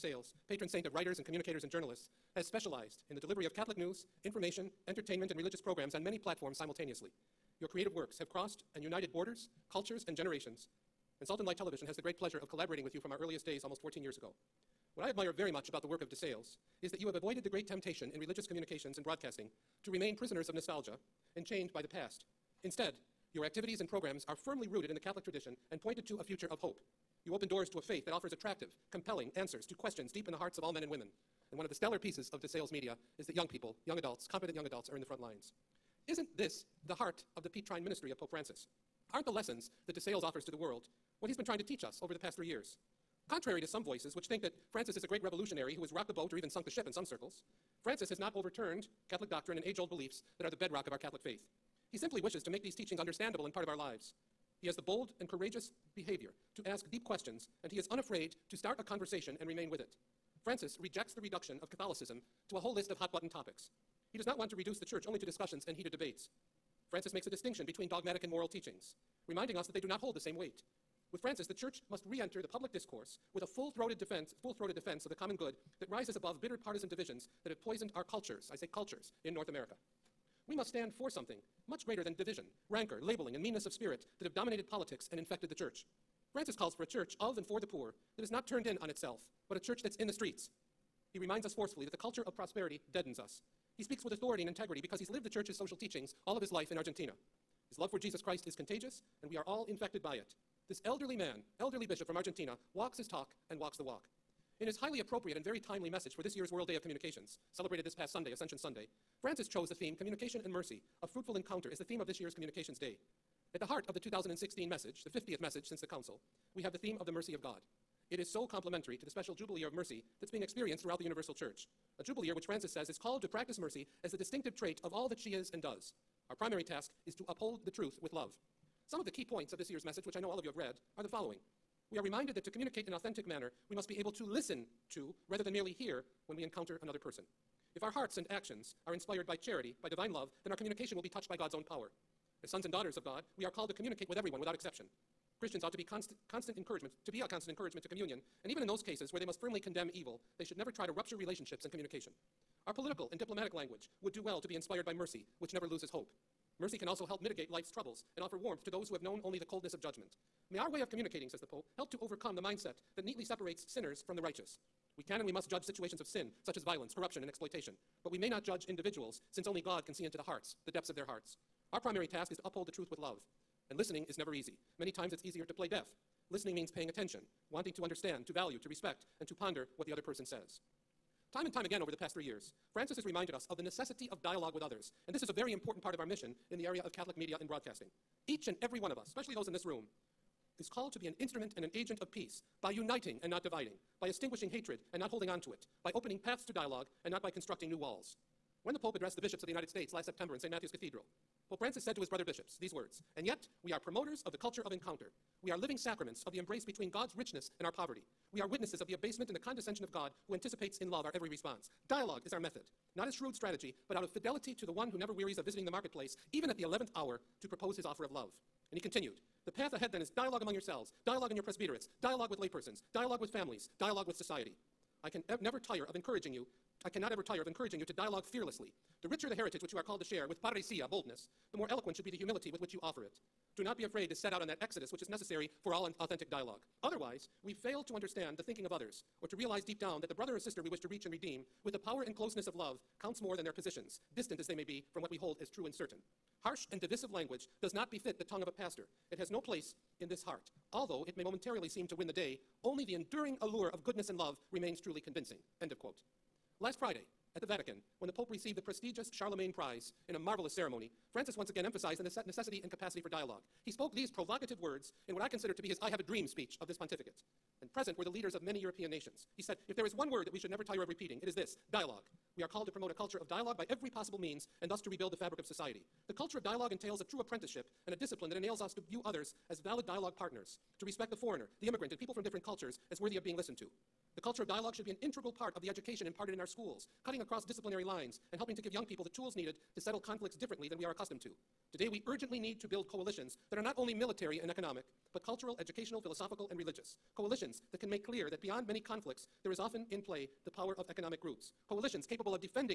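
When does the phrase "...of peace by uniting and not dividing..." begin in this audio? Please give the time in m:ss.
3:12.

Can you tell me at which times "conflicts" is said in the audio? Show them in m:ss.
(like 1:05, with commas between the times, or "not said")
4:49, 4:58.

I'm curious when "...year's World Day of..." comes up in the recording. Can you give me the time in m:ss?
1:46.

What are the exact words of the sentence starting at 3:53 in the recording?
Do not be afraid to set out on that exodus which is necessary for all authentic dialogue.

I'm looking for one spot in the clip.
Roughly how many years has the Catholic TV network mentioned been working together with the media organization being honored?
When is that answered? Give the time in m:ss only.
0:13.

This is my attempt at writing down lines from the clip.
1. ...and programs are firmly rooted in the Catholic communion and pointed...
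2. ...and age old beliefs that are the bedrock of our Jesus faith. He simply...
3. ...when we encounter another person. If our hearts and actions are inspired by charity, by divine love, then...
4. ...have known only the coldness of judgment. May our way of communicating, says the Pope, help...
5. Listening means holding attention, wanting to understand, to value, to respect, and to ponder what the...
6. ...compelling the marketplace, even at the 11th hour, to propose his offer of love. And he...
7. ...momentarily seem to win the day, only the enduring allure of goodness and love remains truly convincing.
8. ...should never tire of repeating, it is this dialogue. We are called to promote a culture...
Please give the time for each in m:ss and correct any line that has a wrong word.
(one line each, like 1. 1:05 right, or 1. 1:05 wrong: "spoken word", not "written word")
1. 0:23 wrong: "tradition", not "communion"
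2. 0:49 wrong: "Catholic", not "Jesus"
3. 2:16 right
4. 2:38 right
5. 2:56 wrong: "paying", not "holding"
6. 3:35 wrong: "visiting", not "compelling"
7. 4:11 right
8. 4:30 right.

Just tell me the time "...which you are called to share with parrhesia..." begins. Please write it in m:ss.
3:49.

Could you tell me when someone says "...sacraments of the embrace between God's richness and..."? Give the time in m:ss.
3:25.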